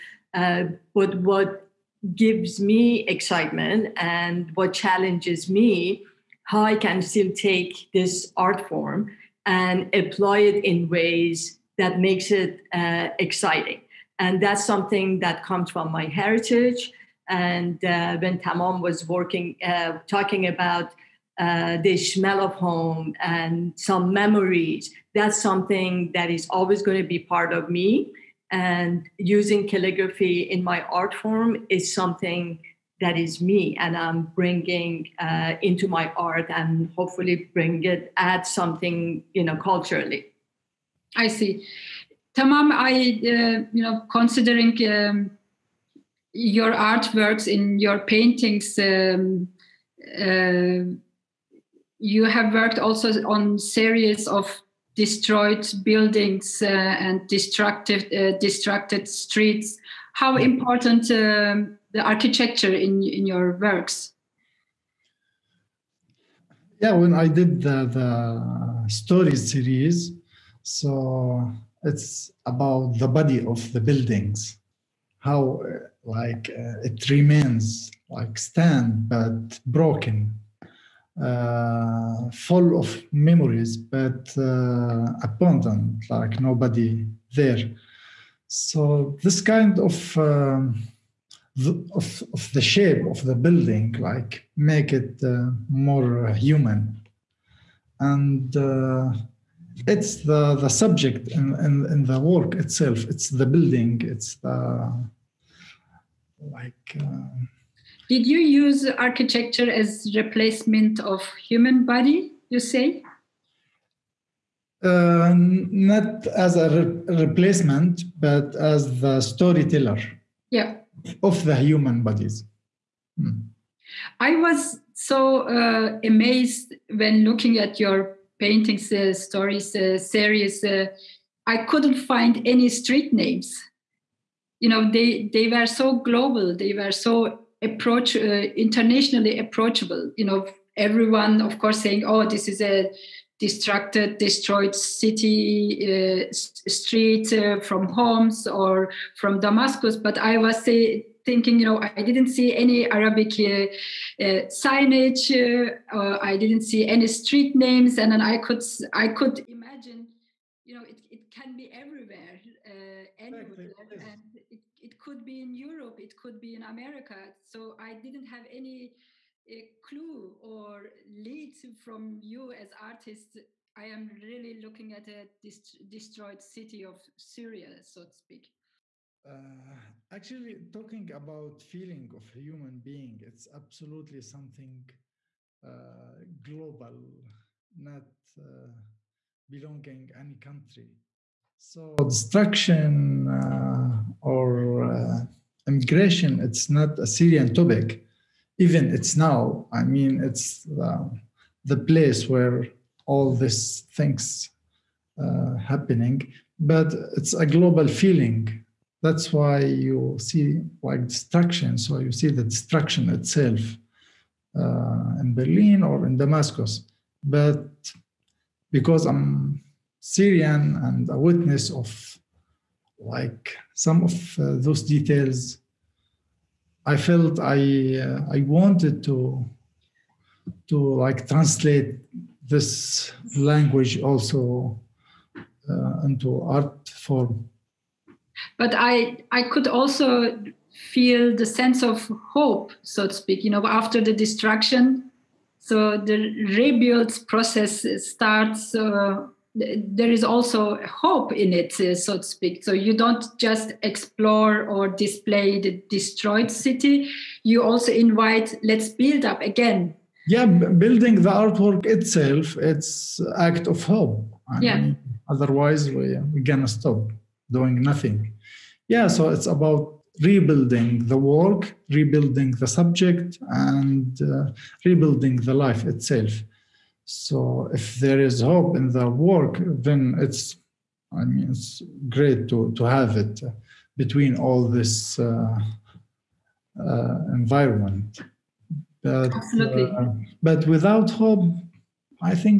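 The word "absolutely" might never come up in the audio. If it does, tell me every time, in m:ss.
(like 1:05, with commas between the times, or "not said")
3:03, 4:49.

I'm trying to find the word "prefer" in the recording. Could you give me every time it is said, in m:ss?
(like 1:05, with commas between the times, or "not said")
not said.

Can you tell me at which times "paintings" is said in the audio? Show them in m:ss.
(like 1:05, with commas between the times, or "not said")
0:47, 2:08.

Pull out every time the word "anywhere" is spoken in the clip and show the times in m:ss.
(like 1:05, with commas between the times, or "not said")
2:43.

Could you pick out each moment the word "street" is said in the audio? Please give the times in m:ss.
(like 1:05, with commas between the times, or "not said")
0:59, 2:12, 2:26, 2:37.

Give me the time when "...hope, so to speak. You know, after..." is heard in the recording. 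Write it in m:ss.
4:02.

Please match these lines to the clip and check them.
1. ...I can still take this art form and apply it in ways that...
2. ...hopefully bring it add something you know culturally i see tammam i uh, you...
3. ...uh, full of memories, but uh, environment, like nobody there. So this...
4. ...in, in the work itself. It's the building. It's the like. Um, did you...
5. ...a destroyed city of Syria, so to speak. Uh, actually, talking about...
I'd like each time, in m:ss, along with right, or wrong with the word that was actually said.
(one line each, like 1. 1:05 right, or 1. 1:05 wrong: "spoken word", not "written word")
1. 0:06 right
2. 0:36 right
3. 1:21 wrong: "abundant", not "environment"
4. 1:41 right
5. 2:55 right.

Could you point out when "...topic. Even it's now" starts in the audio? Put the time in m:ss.
3:17.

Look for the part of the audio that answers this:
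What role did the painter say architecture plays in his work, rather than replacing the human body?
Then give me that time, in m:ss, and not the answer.
1:59.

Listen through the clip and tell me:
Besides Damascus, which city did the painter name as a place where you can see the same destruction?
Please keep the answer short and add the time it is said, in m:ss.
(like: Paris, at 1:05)
Berlin, at 3:35.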